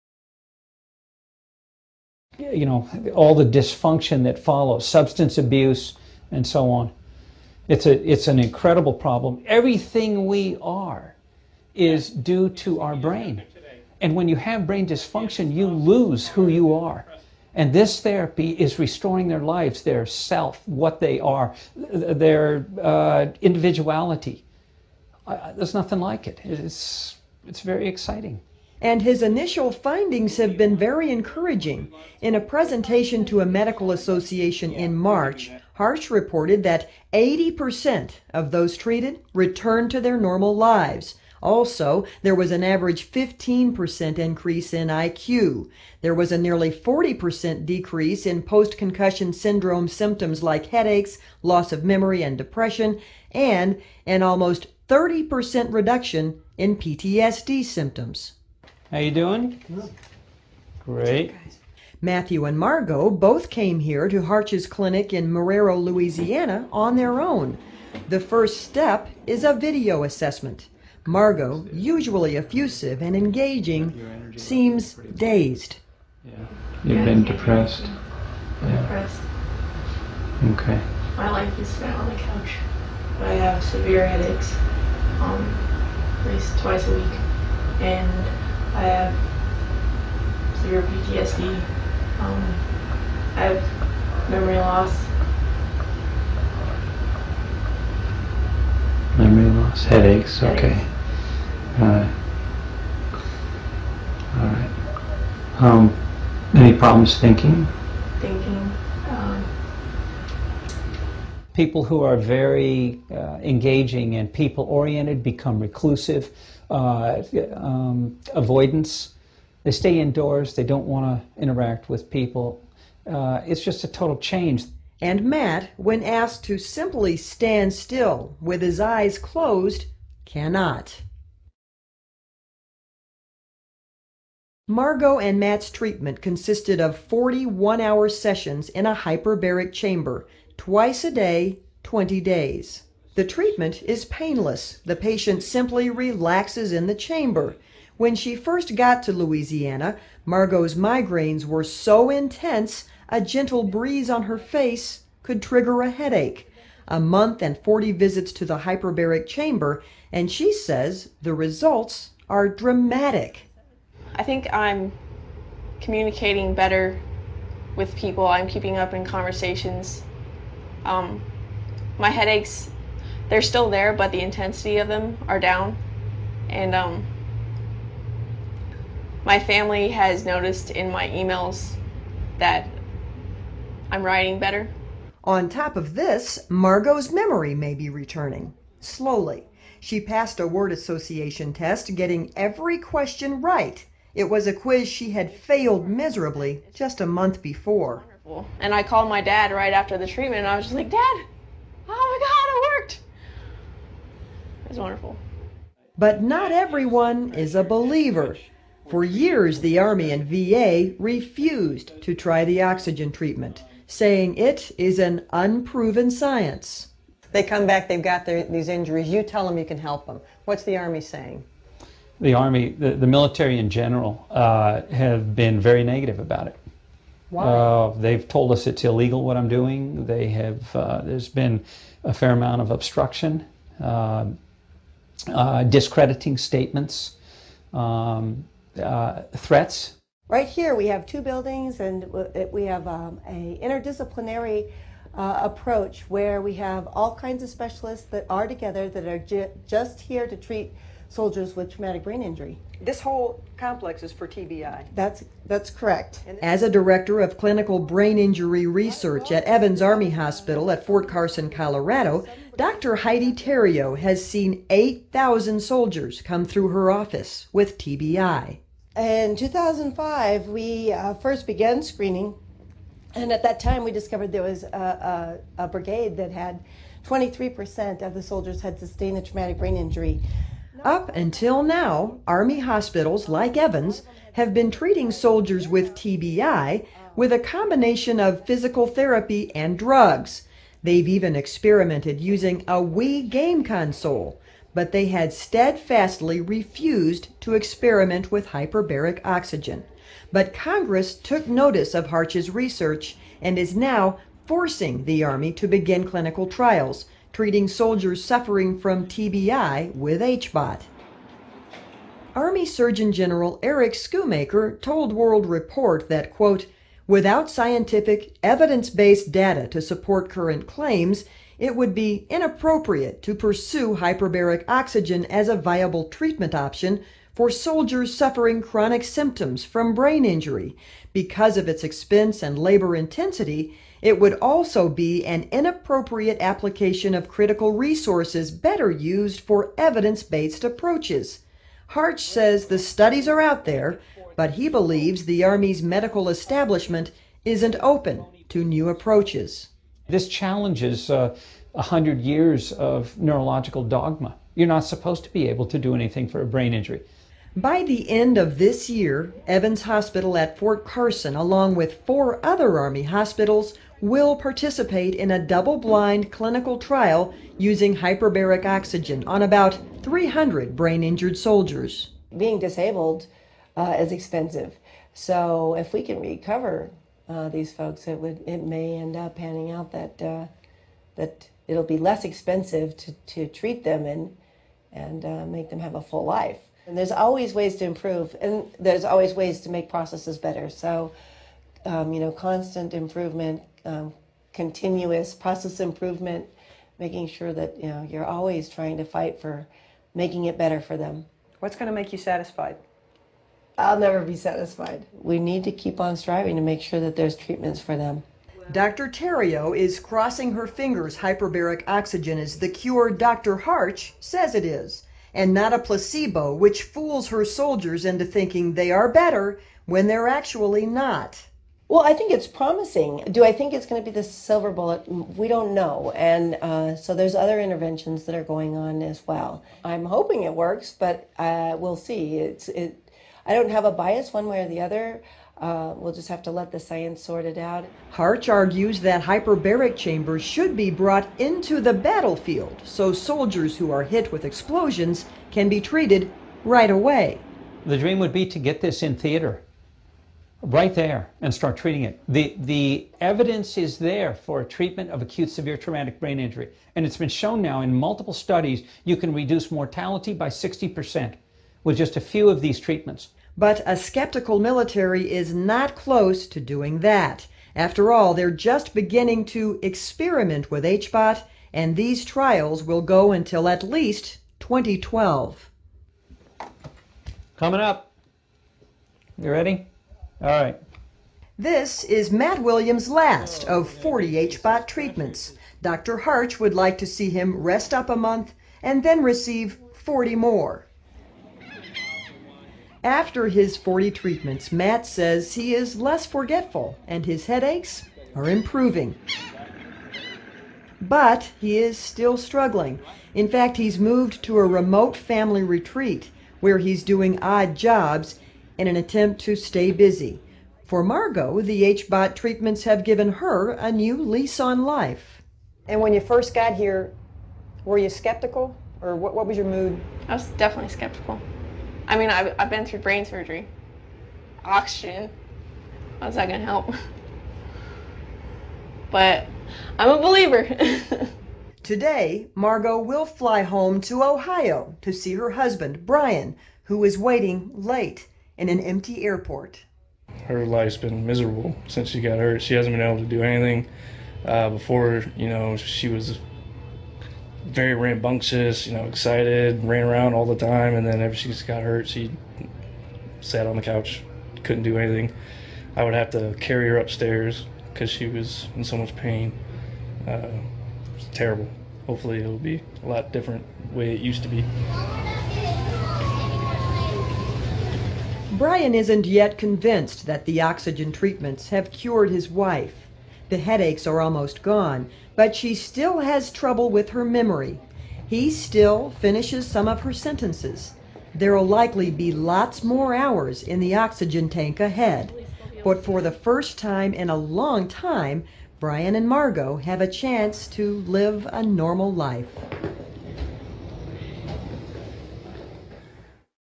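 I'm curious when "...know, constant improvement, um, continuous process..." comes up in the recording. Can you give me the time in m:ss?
6:32.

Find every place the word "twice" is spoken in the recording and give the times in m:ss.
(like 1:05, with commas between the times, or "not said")
1:26, 2:20.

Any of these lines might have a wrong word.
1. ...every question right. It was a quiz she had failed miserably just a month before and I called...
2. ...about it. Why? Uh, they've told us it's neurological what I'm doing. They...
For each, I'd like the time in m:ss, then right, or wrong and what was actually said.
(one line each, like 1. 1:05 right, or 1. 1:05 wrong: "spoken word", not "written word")
1. 3:12 right
2. 3:46 wrong: "illegal", not "neurological".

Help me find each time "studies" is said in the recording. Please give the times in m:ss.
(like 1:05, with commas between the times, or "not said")
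5:42, 7:38.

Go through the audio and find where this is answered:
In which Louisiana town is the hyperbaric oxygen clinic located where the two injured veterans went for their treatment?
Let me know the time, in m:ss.
1:05.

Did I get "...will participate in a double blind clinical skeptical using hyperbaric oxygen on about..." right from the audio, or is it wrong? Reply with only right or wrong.
wrong.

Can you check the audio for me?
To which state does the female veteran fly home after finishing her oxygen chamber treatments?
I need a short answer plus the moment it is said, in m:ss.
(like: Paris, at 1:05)
Ohio, at 8:54.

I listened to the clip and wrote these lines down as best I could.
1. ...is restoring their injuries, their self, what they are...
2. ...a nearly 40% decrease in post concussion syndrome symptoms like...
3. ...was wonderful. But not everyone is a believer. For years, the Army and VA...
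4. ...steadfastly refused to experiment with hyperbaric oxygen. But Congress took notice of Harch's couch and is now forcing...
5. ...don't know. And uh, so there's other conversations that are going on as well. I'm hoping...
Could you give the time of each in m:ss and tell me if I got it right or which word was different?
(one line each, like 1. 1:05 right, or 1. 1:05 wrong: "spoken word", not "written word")
1. 0:18 wrong: "lives", not "injuries"
2. 0:46 right
3. 3:24 right
4. 4:55 wrong: "research", not "couch"
5. 7:05 wrong: "interventions", not "conversations".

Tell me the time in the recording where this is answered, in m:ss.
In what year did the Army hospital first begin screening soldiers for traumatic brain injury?
4:29.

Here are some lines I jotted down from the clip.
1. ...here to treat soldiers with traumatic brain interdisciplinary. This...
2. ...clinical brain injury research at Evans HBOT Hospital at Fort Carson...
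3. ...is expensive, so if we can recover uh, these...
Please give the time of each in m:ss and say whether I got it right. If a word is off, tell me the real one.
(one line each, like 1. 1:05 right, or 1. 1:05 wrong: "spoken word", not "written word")
1. 4:09 wrong: "injury", not "interdisciplinary"
2. 4:17 wrong: "Army", not "HBOT"
3. 6:13 right.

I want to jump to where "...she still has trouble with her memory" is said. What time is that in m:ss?
9:35.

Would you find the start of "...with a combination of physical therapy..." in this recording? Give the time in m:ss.
4:47.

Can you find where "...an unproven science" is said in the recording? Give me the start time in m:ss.
3:34.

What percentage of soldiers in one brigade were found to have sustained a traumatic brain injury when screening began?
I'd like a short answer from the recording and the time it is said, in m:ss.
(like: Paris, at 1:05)
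23%, at 4:37.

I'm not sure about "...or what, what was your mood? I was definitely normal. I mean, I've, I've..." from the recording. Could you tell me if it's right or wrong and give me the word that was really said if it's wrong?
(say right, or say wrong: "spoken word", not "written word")
wrong: "skeptical", not "normal".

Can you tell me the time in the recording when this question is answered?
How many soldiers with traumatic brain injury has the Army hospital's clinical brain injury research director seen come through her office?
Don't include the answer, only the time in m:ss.
4:24.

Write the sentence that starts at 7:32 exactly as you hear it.
The, the evidence is there for treatment of acute severe traumatic brain injury.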